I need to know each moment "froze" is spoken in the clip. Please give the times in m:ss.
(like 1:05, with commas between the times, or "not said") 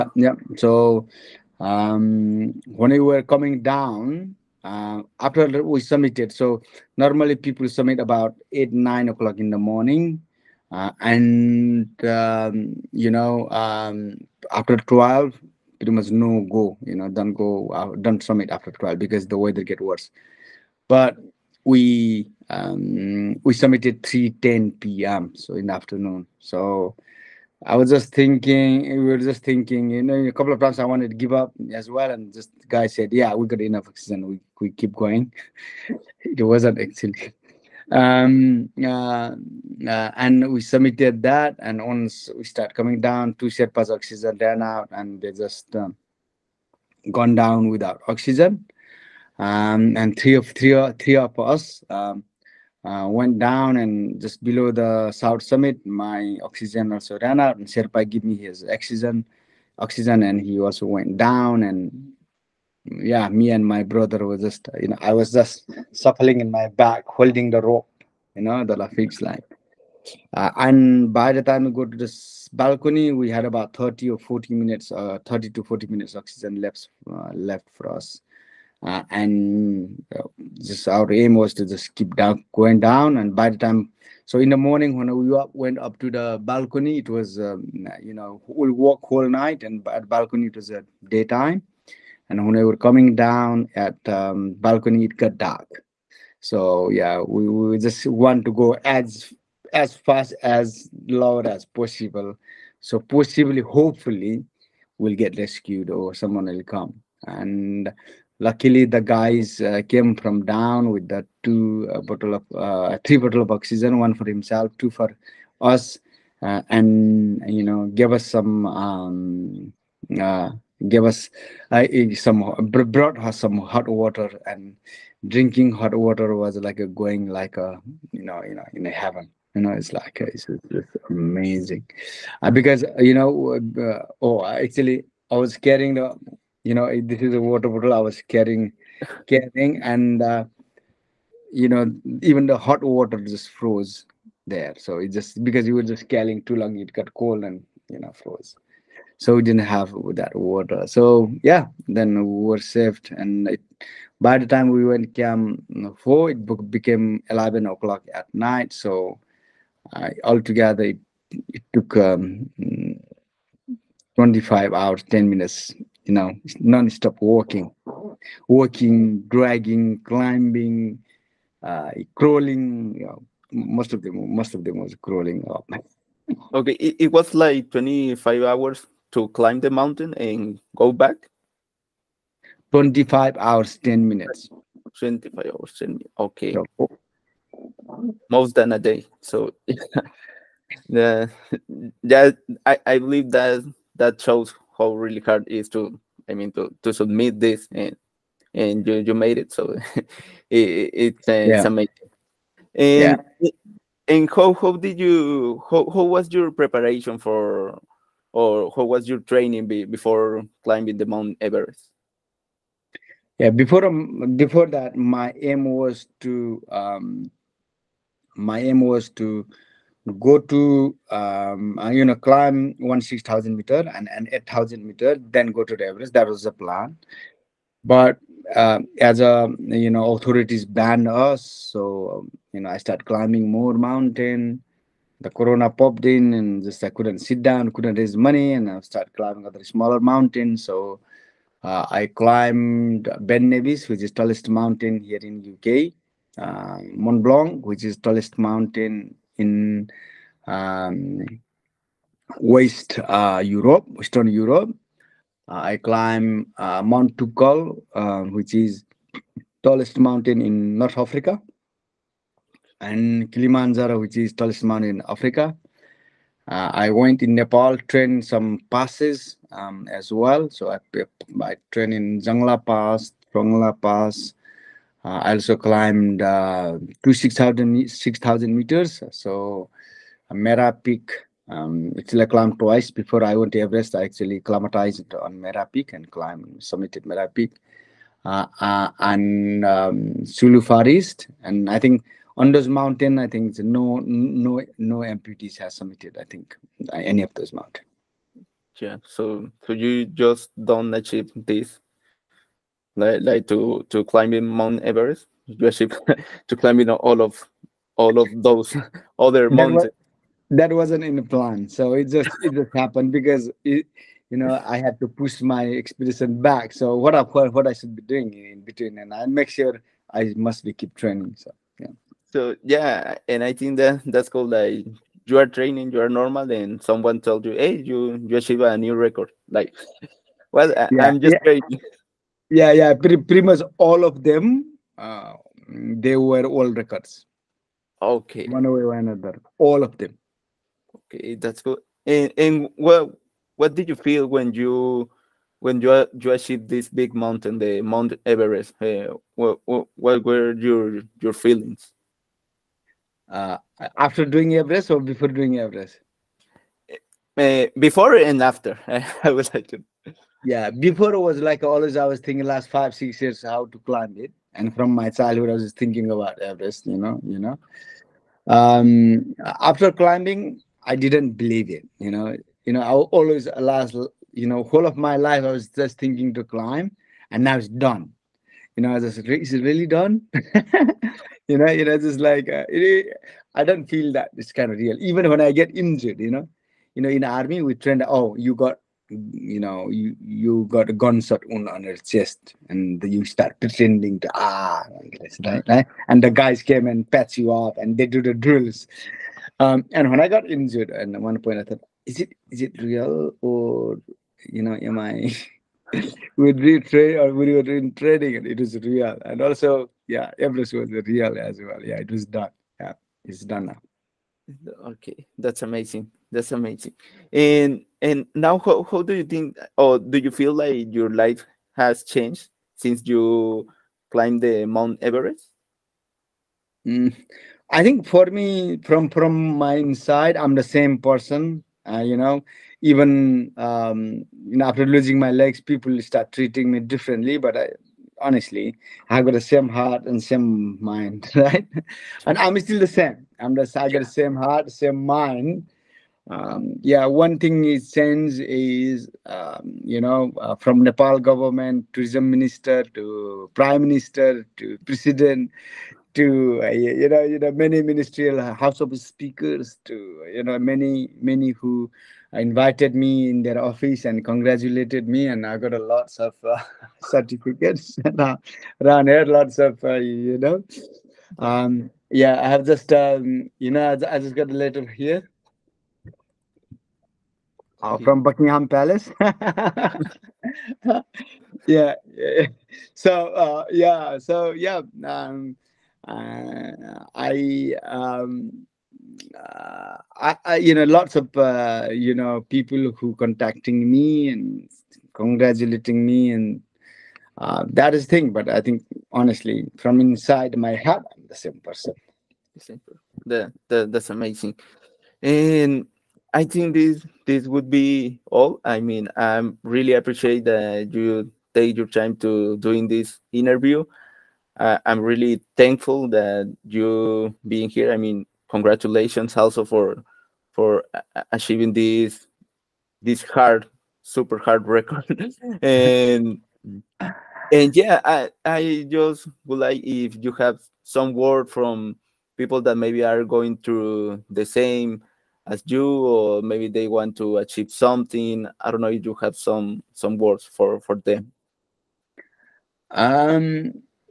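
2:23, 2:28.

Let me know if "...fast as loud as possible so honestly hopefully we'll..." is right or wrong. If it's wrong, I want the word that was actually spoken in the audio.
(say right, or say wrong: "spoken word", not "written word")
wrong: "possibly", not "honestly".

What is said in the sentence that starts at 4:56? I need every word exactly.
I think uh, any of those mountain.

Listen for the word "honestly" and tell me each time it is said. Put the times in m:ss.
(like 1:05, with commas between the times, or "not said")
7:18, 8:19.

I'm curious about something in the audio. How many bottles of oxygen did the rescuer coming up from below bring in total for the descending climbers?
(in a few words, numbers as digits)
3.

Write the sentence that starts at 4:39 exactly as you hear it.
So uh, Mera Peak, um, actually I climbed twice before I went to Everest.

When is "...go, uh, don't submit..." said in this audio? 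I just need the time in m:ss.
0:17.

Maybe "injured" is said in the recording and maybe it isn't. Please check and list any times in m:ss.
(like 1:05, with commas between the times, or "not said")
6:25, 6:40.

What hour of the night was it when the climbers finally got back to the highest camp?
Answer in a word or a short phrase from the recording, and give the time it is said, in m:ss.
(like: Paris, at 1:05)
11 o'clock, at 2:37.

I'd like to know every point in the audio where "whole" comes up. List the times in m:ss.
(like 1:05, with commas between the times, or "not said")
1:29, 6:14.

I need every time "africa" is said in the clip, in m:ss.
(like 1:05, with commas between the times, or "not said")
4:20, 4:25.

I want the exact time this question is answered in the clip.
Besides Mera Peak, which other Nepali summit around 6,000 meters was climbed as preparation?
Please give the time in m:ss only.
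4:50.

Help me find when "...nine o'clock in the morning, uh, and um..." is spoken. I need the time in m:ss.
0:08.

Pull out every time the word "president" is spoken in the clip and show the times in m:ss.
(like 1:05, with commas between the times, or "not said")
7:34.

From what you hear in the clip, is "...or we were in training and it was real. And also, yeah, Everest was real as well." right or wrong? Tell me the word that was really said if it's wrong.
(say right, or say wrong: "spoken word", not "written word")
right.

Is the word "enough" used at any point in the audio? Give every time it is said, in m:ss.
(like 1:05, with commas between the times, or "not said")
0:33.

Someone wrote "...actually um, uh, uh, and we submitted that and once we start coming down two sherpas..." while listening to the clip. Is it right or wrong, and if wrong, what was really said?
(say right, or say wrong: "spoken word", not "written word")
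right.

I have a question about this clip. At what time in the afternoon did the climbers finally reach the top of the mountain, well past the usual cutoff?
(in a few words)
3:10 p.m.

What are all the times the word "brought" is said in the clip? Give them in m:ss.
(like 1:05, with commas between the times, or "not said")
2:02.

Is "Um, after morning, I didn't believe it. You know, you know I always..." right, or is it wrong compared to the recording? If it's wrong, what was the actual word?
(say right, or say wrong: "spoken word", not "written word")
wrong: "climbing", not "morning".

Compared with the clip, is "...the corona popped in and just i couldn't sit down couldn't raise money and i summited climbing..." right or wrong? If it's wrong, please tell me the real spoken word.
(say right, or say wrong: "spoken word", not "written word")
wrong: "started", not "summited".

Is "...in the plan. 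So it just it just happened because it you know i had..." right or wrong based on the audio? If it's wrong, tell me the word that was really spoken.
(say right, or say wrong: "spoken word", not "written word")
right.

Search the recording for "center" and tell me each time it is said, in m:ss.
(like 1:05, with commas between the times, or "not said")
not said.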